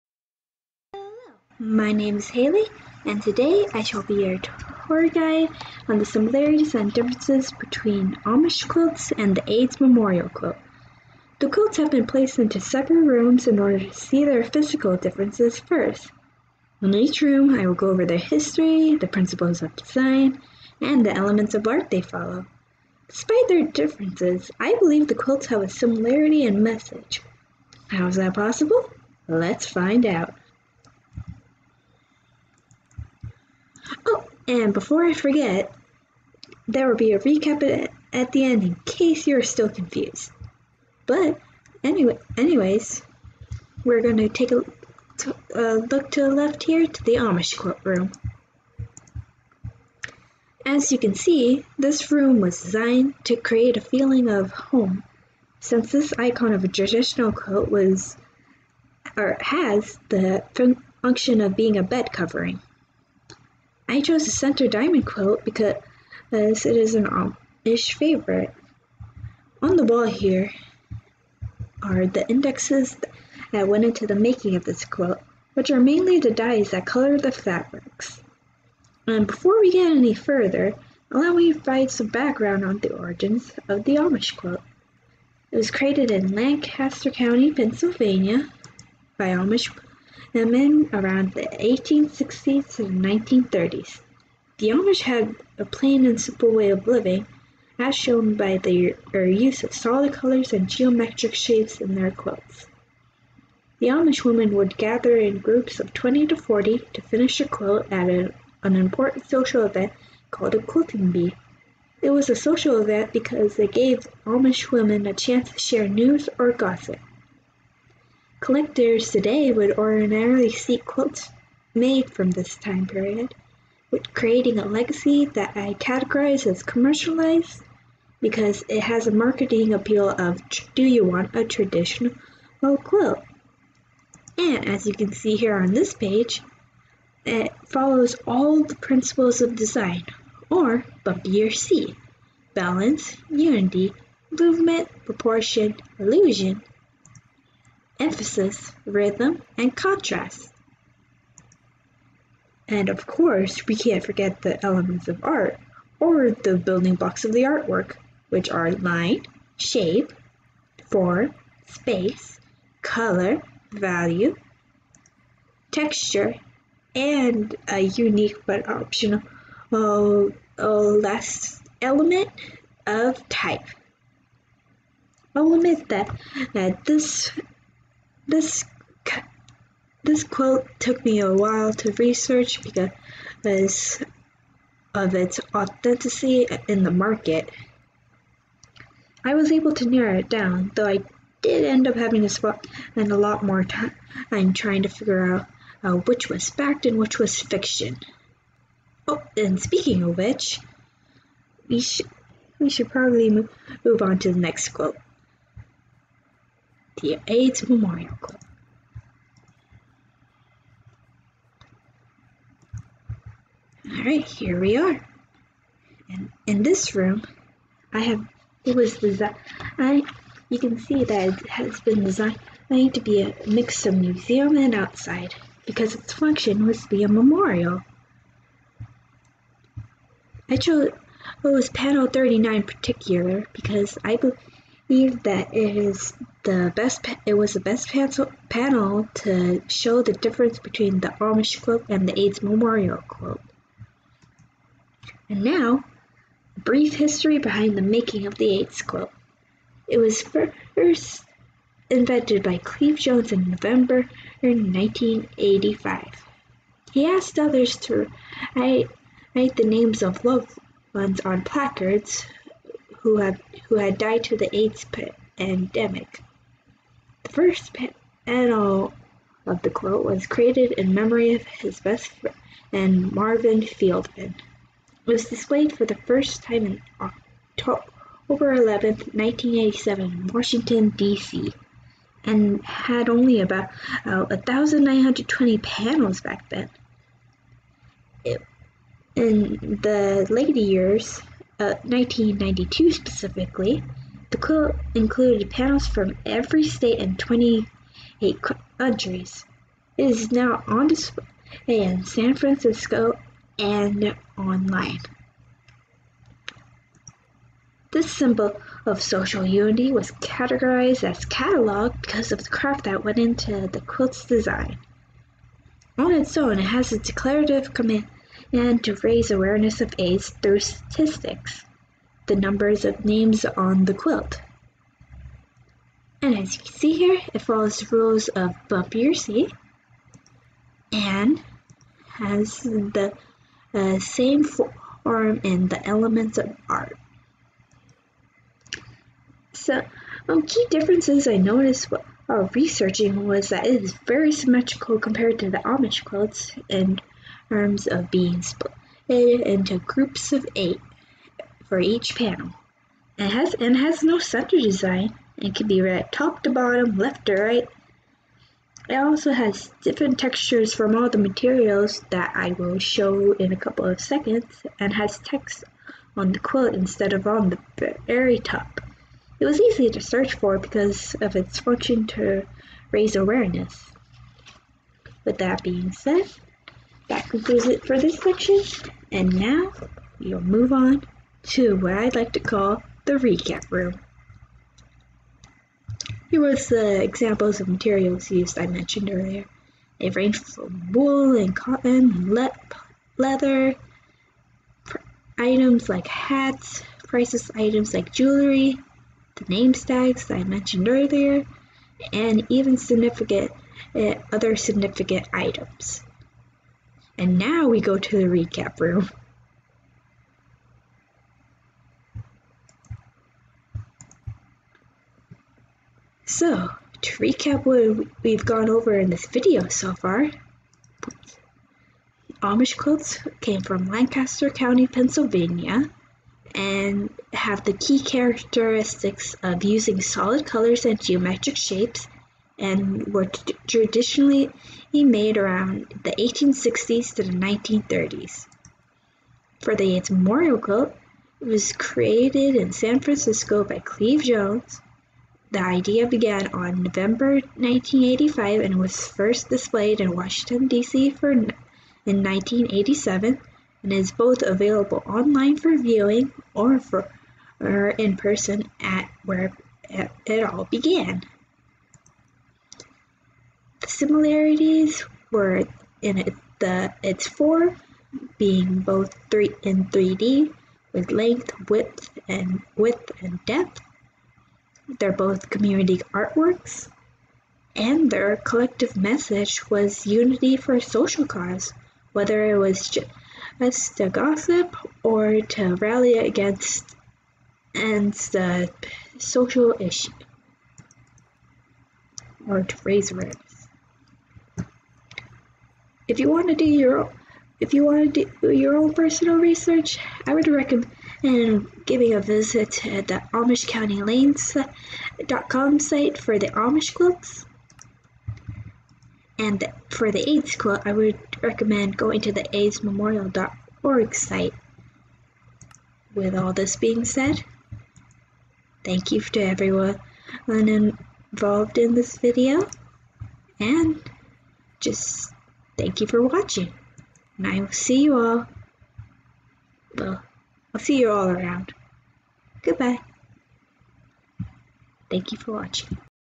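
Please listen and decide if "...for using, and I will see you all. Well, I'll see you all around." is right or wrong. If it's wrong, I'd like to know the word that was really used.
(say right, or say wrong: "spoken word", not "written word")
wrong: "watching", not "using".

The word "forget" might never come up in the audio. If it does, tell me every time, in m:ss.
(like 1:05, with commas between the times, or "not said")
0:35, 2:34.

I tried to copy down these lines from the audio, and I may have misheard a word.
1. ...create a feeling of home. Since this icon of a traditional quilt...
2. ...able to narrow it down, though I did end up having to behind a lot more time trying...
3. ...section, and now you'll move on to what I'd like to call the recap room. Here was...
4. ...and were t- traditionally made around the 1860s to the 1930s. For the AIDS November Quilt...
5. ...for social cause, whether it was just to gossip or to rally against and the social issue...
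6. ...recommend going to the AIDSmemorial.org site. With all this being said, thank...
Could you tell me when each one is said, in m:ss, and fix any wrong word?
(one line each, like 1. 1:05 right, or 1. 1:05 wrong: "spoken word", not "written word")
1. 0:53 right
2. 3:09 wrong: "spend", not "behind"
3. 6:18 right
4. 7:12 wrong: "Memorial", not "November"
5. 8:00 right
6. 8:31 right.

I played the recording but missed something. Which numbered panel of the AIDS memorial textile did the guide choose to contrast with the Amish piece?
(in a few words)
39.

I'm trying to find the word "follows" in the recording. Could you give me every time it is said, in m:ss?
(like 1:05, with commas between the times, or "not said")
0:22, 2:17, 5:27.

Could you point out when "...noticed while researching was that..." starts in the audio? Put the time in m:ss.
5:41.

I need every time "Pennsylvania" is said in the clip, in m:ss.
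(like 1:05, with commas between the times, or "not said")
1:27, 7:04.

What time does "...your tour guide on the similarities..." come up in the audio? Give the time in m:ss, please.
0:04.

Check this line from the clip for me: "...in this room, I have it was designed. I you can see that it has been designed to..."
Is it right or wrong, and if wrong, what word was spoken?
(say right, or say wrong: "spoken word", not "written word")
right.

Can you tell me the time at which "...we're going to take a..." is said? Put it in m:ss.
0:43.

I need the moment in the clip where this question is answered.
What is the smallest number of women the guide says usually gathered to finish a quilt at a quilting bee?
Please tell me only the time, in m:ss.
1:45.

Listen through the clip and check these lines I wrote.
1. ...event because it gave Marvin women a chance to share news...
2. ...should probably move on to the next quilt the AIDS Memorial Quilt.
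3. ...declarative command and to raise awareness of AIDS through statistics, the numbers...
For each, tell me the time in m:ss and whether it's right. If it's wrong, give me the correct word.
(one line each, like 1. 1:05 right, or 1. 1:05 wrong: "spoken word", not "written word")
1. 1:52 wrong: "Amish", not "Marvin"
2. 3:22 right
3. 5:16 right.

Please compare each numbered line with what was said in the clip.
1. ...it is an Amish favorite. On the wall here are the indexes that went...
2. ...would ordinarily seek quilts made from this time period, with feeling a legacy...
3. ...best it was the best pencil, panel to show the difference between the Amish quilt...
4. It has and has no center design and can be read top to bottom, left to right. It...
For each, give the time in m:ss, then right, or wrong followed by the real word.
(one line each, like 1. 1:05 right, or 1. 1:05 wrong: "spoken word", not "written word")
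1. 1:06 right
2. 1:59 wrong: "creating", not "feeling"
3. 3:56 right
4. 5:53 right.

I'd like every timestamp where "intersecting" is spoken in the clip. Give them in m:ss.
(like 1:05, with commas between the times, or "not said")
not said.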